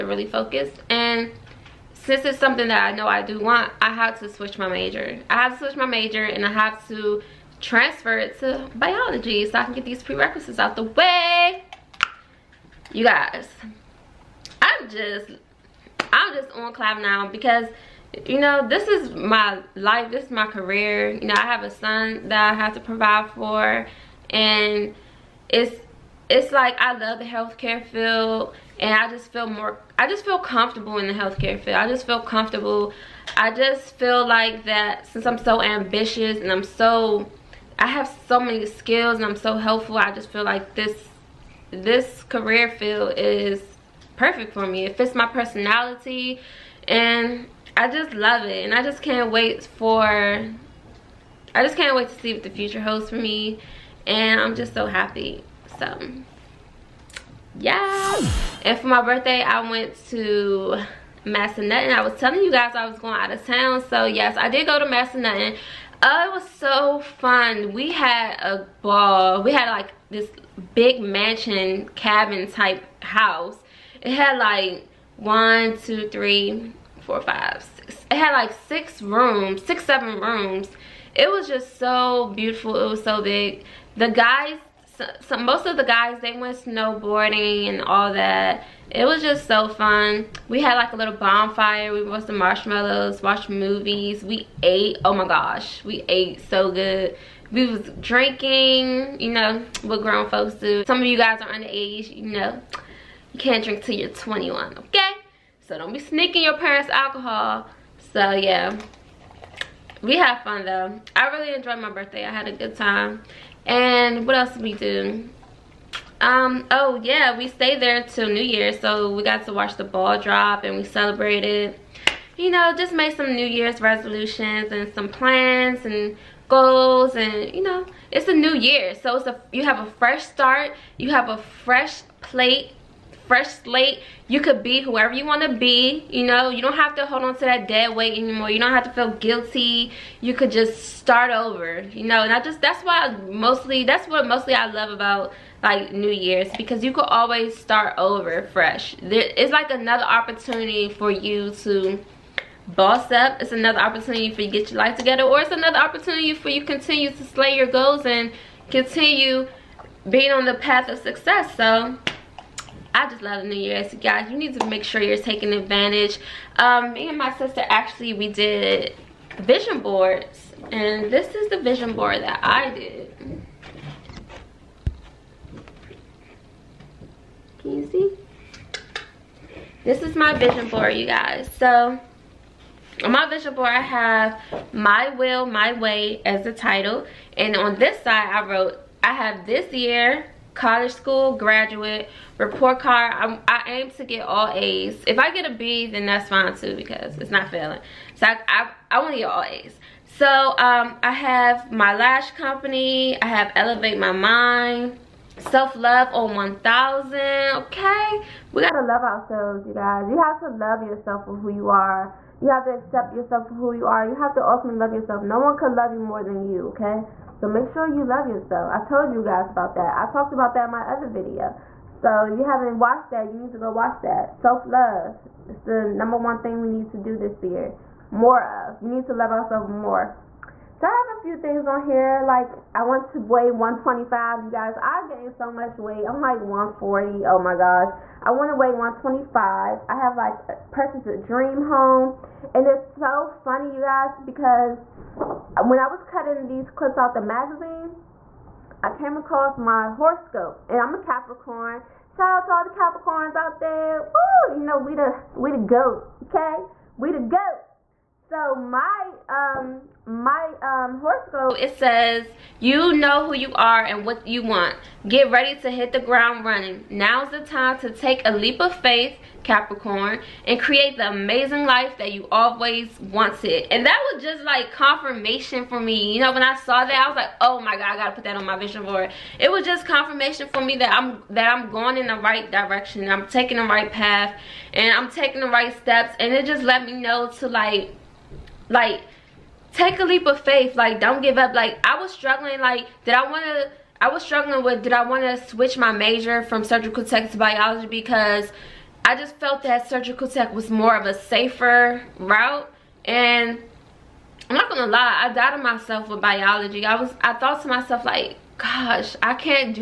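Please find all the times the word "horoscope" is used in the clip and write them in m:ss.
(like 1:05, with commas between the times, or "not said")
4:09, 4:21.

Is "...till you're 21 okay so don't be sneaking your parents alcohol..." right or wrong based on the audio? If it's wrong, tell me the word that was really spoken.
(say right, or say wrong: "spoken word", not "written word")
right.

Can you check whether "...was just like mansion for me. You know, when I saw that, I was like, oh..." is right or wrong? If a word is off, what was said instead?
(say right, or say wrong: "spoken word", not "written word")
wrong: "confirmation", not "mansion".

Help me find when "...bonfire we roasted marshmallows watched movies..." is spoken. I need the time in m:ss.
1:31.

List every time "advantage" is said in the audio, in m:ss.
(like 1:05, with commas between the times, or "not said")
2:45.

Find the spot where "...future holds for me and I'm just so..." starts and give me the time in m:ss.
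0:52.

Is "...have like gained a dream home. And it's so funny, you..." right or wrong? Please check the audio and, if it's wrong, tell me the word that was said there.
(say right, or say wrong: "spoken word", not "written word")
wrong: "purchased", not "gained".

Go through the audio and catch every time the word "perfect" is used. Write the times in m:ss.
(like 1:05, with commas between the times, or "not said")
0:44.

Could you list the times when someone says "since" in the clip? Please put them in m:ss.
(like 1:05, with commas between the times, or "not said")
0:02, 0:35.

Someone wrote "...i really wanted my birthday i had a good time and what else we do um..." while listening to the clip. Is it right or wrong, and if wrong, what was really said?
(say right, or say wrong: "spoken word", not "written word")
wrong: "enjoyed", not "wanted".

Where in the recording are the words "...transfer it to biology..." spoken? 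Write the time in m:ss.
0:07.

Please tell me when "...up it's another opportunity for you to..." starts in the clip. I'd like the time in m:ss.
2:33.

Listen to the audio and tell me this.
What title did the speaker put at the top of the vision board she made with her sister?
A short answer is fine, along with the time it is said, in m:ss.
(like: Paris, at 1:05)
My Will, My Way, at 3:04.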